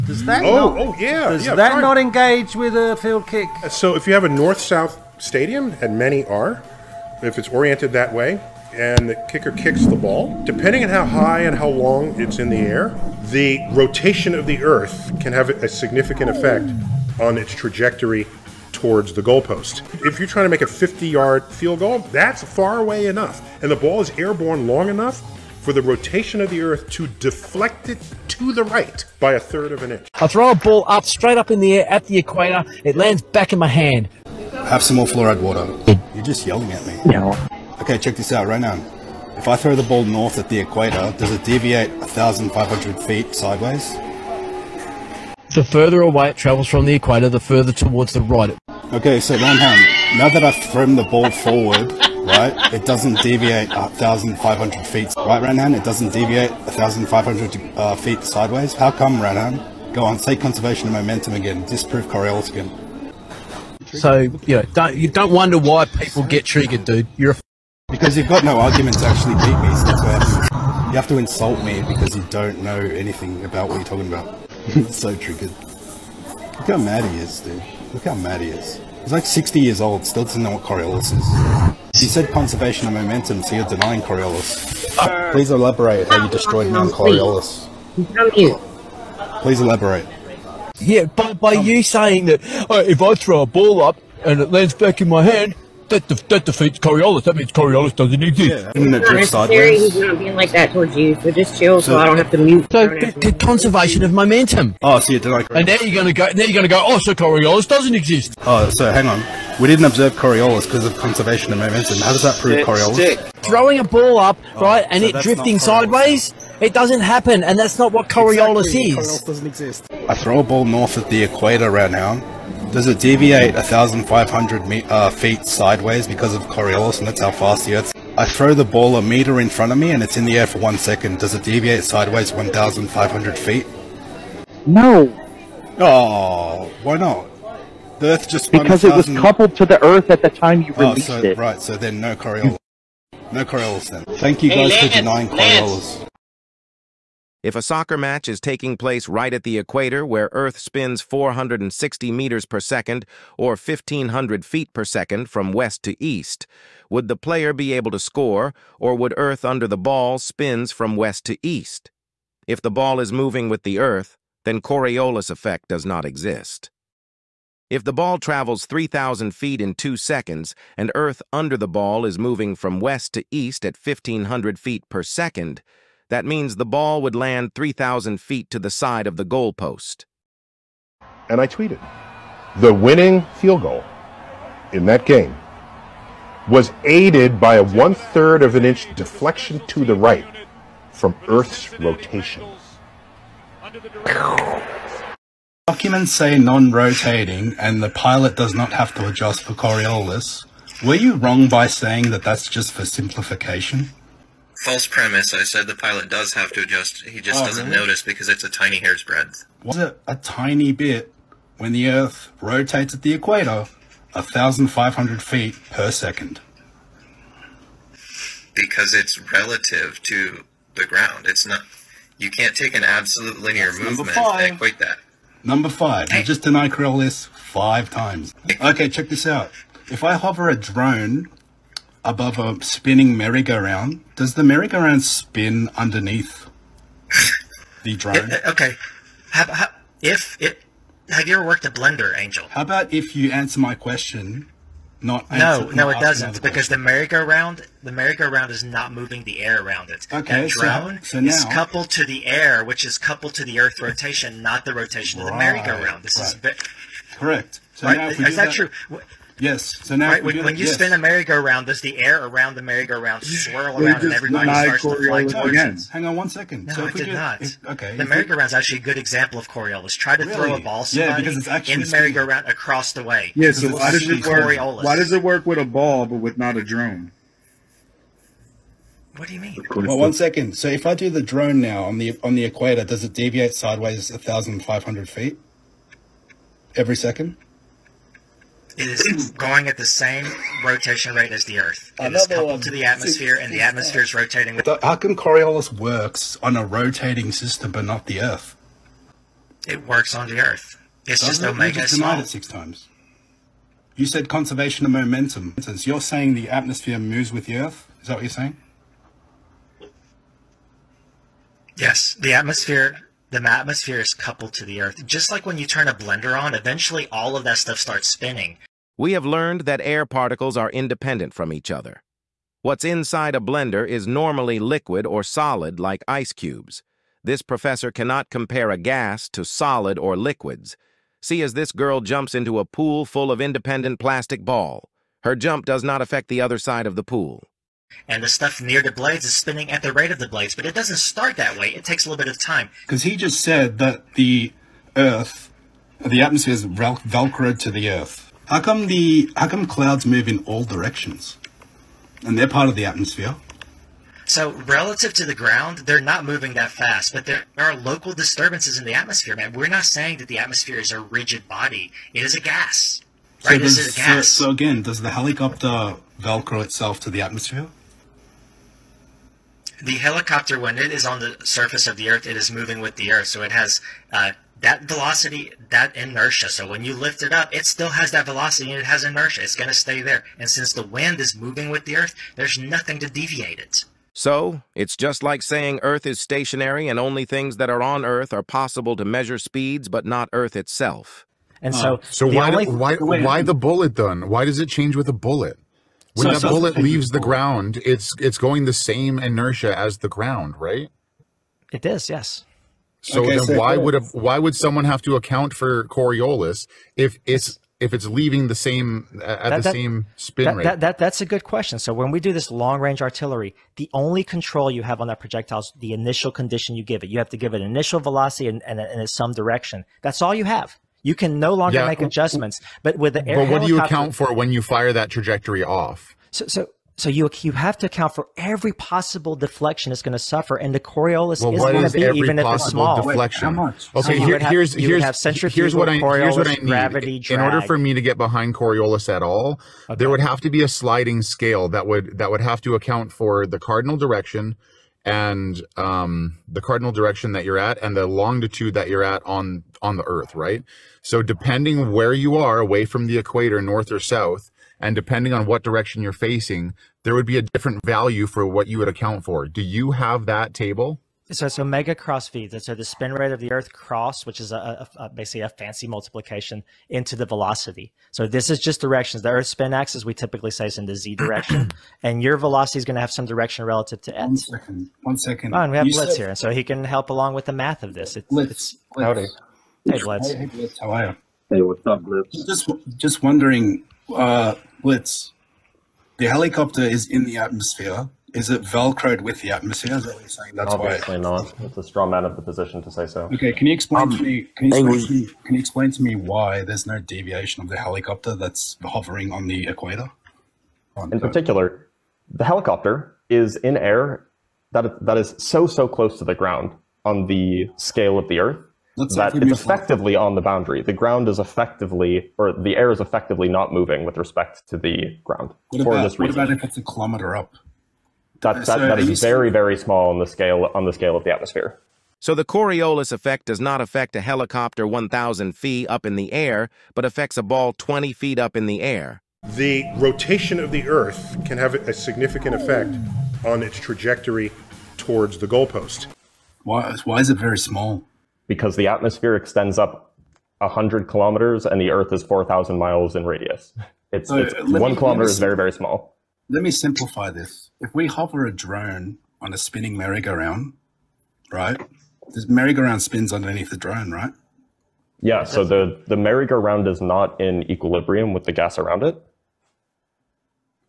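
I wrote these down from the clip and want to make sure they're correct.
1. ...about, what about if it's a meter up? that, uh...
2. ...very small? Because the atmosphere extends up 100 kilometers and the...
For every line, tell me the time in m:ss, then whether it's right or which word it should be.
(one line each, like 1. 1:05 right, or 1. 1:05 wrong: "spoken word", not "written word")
1. 8:35 wrong: "kilometer", not "meter"
2. 8:57 right.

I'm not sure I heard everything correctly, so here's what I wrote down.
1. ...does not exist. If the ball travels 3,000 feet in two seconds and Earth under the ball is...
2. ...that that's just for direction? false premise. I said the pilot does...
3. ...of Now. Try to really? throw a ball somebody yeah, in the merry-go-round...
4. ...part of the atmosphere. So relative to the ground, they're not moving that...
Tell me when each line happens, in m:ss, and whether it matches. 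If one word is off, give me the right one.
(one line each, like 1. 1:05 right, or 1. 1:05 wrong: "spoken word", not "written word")
1. 2:45 right
2. 3:22 wrong: "simplification", not "direction"
3. 4:29 wrong: "Coriolis", not "Now"
4. 5:52 right.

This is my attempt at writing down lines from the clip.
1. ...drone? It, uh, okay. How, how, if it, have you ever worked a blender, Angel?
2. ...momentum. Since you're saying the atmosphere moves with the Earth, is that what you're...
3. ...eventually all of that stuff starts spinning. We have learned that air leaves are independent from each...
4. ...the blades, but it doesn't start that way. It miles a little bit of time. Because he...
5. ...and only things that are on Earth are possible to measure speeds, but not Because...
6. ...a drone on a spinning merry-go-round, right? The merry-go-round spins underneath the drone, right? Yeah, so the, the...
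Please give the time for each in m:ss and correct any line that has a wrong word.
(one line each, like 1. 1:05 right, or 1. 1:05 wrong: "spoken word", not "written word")
1. 3:57 right
2. 5:04 right
3. 5:16 wrong: "particles", not "leaves"
4. 5:40 wrong: "takes", not "miles"
5. 6:26 wrong: "Earth", not "Because"
6. 9:08 right.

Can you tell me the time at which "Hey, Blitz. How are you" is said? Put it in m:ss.
8:00.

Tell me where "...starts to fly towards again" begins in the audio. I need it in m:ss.
4:24.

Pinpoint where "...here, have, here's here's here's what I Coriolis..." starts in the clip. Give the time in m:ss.
7:14.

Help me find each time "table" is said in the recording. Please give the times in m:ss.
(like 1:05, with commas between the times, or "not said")
7:40.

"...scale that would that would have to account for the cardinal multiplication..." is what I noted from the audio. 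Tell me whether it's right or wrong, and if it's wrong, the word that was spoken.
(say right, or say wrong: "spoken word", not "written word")
wrong: "direction", not "multiplication".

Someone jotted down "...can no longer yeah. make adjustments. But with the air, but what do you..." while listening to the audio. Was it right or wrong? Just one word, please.
right.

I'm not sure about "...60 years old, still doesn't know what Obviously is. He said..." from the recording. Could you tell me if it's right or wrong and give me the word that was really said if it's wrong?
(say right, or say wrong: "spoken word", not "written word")
wrong: "Coriolis", not "Obviously".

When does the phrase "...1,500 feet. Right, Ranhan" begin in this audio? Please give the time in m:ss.
0:53.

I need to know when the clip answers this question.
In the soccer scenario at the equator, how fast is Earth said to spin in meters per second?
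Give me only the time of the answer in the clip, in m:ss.
2:31.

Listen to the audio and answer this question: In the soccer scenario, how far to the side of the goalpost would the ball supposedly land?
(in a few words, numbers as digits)
3,000 feet.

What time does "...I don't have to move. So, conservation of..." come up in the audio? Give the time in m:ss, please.
1:41.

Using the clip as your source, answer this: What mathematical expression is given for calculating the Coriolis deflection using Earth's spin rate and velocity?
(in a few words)
omega cross v.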